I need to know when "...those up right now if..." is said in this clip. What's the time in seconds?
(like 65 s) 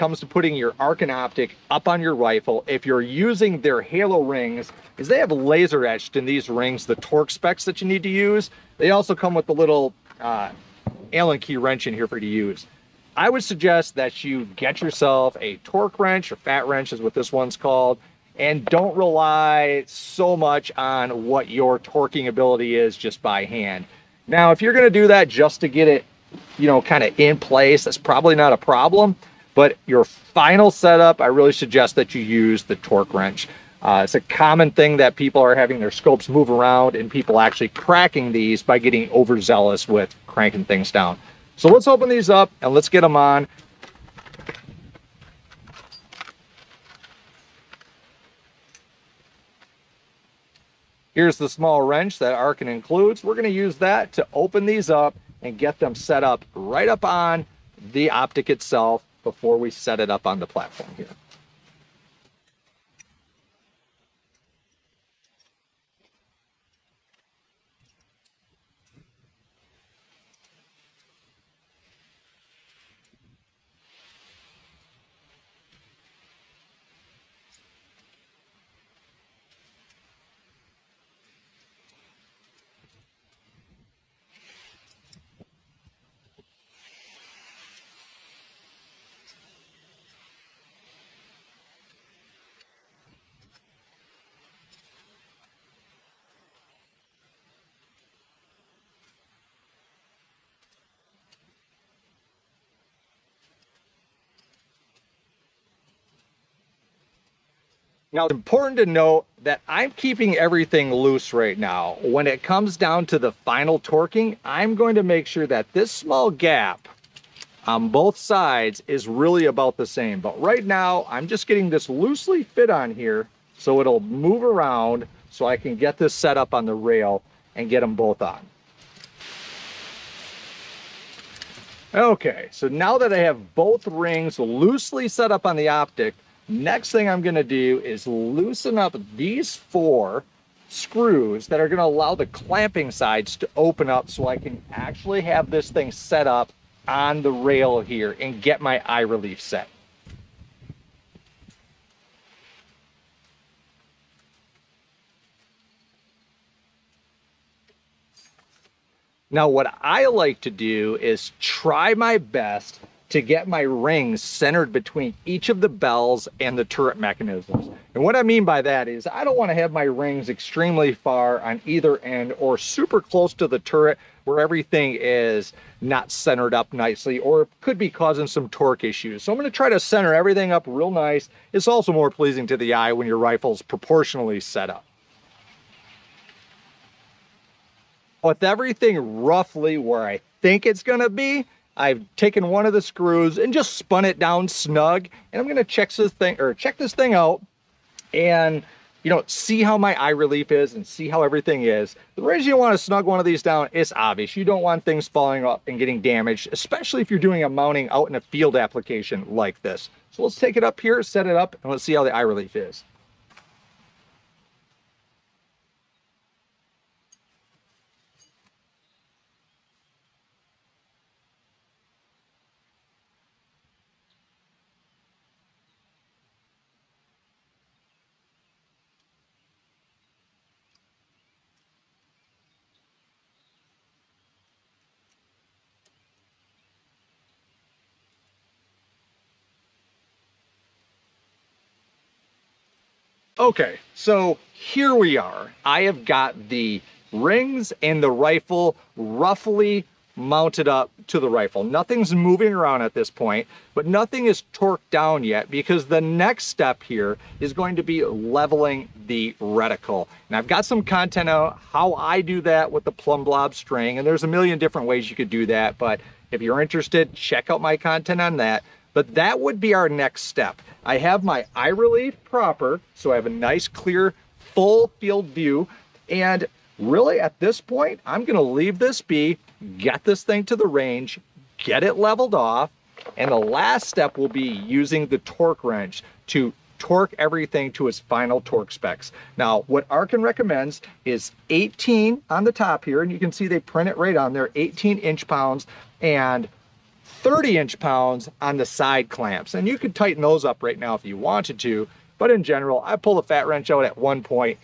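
300 s.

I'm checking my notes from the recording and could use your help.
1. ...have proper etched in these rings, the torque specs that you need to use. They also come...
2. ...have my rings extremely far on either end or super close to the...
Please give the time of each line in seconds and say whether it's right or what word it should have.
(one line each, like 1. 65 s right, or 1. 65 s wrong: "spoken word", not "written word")
1. 5 s wrong: "laser", not "proper"
2. 169 s right.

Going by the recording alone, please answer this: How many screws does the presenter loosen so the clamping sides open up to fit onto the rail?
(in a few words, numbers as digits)
4.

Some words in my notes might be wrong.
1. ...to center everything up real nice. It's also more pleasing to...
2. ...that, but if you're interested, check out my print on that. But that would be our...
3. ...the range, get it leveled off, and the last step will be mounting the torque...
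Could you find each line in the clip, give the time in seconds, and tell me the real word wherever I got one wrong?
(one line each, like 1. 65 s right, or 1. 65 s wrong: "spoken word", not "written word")
1. 179 s right
2. 265 s wrong: "content", not "print"
3. 280 s wrong: "using", not "mounting".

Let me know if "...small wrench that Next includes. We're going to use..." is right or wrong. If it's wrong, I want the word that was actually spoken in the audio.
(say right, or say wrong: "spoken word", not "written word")
wrong: "Arken", not "Next".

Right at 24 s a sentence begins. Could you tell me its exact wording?
Now, if you're going to do that just to get it, you know, kind of in place, that's probably not a problem.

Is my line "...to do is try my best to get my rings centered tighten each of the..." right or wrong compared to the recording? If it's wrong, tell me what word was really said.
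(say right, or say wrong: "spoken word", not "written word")
wrong: "between", not "tighten".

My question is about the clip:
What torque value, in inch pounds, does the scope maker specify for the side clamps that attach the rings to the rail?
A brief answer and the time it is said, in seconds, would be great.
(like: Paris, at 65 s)
30, at 297 s.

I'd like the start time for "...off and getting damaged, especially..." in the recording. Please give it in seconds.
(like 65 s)
205 s.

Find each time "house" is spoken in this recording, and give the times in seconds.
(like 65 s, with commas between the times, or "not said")
not said.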